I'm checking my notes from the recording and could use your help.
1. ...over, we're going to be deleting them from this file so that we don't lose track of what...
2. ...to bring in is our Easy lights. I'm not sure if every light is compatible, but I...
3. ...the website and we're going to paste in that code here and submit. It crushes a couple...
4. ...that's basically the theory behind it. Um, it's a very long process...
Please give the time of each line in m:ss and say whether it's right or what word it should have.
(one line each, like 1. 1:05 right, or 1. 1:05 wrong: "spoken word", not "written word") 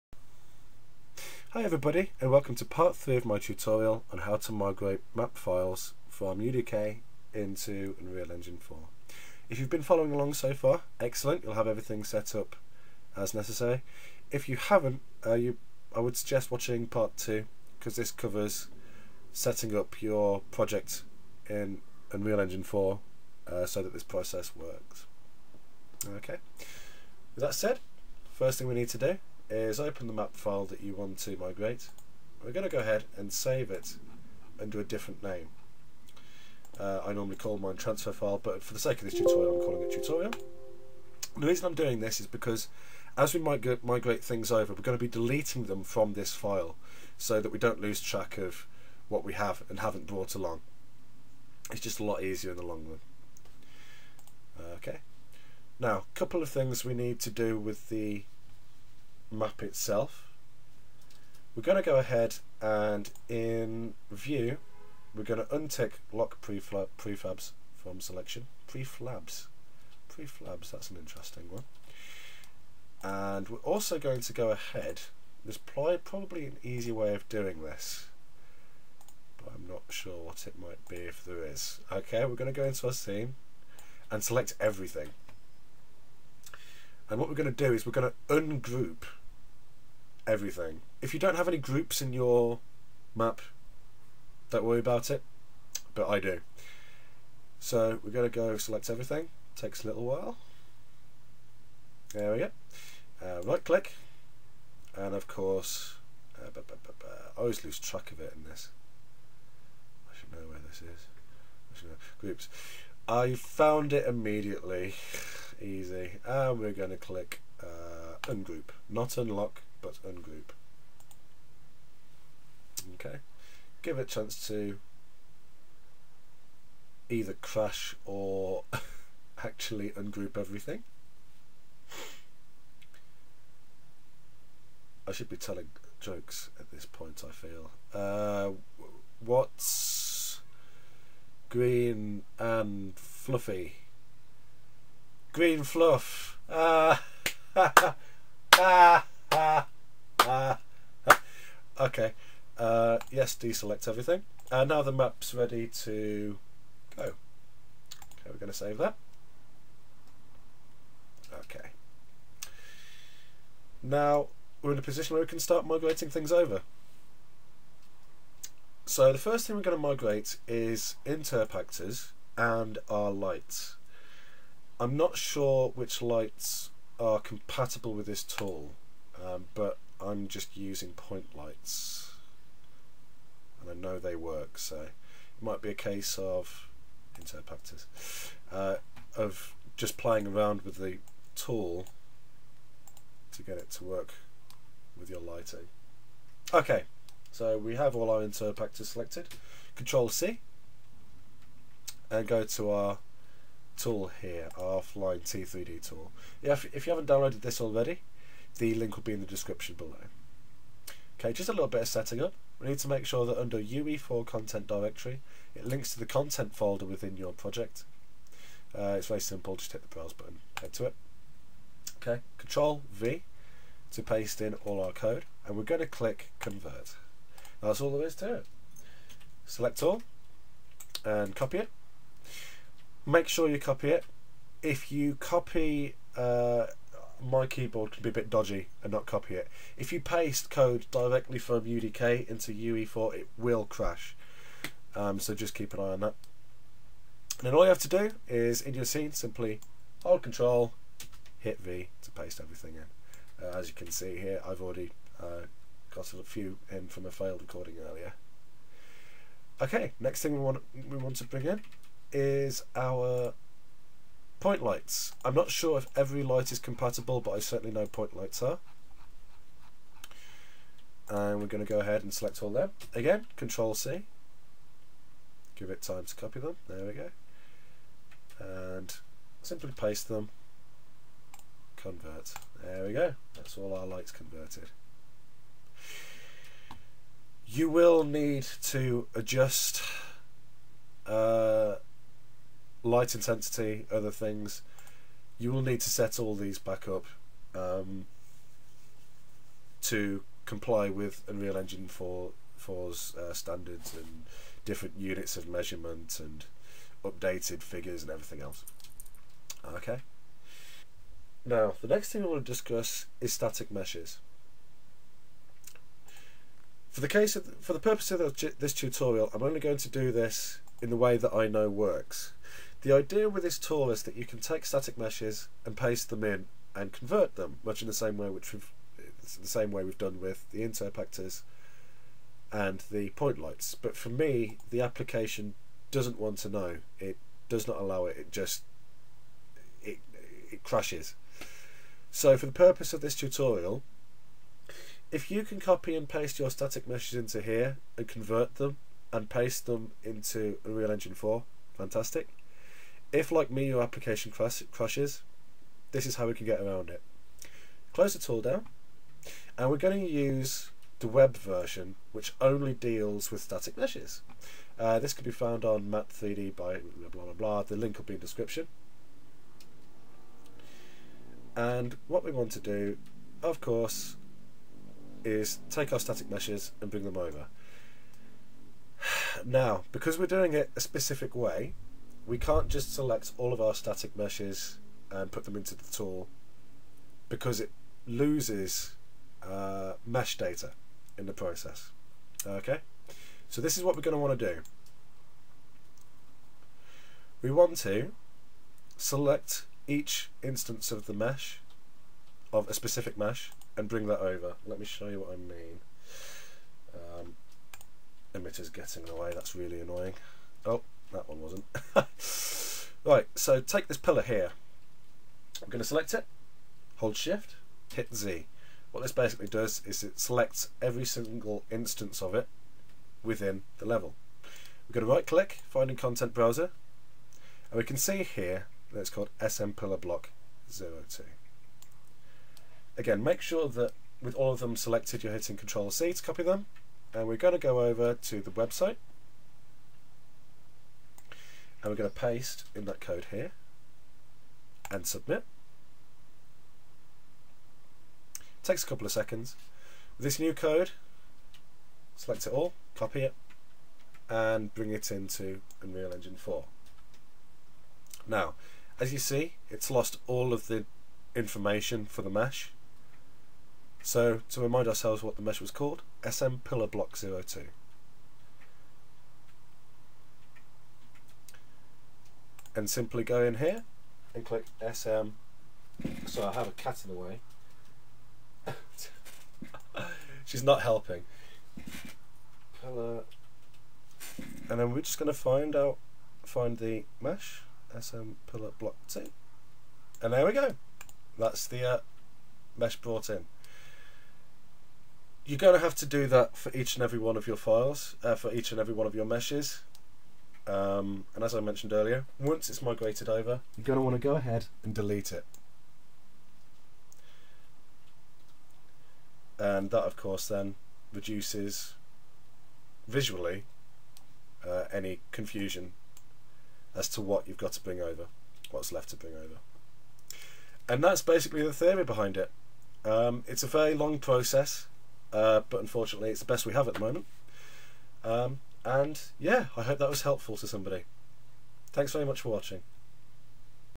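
1. 0:44 right
2. 4:21 wrong: "Point", not "Easy"
3. 7:18 wrong: "takes", not "crushes"
4. 8:41 right.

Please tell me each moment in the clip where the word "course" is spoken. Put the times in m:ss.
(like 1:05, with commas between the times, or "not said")
1:45, 6:13, 8:30.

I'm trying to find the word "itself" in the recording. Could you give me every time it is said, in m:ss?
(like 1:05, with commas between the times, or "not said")
0:59.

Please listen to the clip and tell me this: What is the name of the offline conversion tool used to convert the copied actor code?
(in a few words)
T3D tool.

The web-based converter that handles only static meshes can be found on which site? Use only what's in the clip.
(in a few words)
Matt3D.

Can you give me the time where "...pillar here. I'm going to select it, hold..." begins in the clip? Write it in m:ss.
6:53.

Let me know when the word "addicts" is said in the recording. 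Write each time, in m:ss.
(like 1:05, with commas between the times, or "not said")
not said.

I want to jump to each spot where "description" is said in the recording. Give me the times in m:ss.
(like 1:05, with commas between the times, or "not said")
3:29, 6:08.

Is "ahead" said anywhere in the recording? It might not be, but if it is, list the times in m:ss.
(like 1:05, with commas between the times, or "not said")
0:32, 1:01, 1:14, 4:31, 8:24.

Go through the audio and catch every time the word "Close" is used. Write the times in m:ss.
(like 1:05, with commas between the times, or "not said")
5:57.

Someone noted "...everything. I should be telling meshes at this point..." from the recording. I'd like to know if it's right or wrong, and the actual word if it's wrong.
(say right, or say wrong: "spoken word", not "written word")
wrong: "jokes", not "meshes".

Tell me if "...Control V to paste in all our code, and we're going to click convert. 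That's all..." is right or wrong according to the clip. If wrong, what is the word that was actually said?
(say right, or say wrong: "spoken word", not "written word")
right.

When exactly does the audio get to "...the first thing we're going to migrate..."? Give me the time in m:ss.
2:49.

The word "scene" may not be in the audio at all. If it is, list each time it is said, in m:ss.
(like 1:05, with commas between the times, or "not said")
1:22, 4:08.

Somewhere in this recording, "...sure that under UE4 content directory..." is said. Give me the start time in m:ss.
3:33.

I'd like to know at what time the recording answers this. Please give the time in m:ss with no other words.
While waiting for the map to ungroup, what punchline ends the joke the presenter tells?
2:25.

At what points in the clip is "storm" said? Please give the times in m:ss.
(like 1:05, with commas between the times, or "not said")
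not said.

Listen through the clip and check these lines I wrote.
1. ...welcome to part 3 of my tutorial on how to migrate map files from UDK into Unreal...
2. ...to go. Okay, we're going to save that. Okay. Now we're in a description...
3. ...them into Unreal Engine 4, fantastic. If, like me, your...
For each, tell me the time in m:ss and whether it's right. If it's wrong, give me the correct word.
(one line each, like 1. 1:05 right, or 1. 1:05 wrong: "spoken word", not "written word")
1. 0:02 right
2. 2:35 wrong: "position", not "description"
3. 5:49 right.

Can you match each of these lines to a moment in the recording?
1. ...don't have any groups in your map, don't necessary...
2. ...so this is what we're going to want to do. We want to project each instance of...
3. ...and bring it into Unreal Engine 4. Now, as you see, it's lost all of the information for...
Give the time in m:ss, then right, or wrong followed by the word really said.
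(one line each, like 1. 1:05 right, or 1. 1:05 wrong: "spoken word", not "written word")
1. 1:31 wrong: "worry", not "necessary"
2. 6:33 wrong: "select", not "project"
3. 7:34 right.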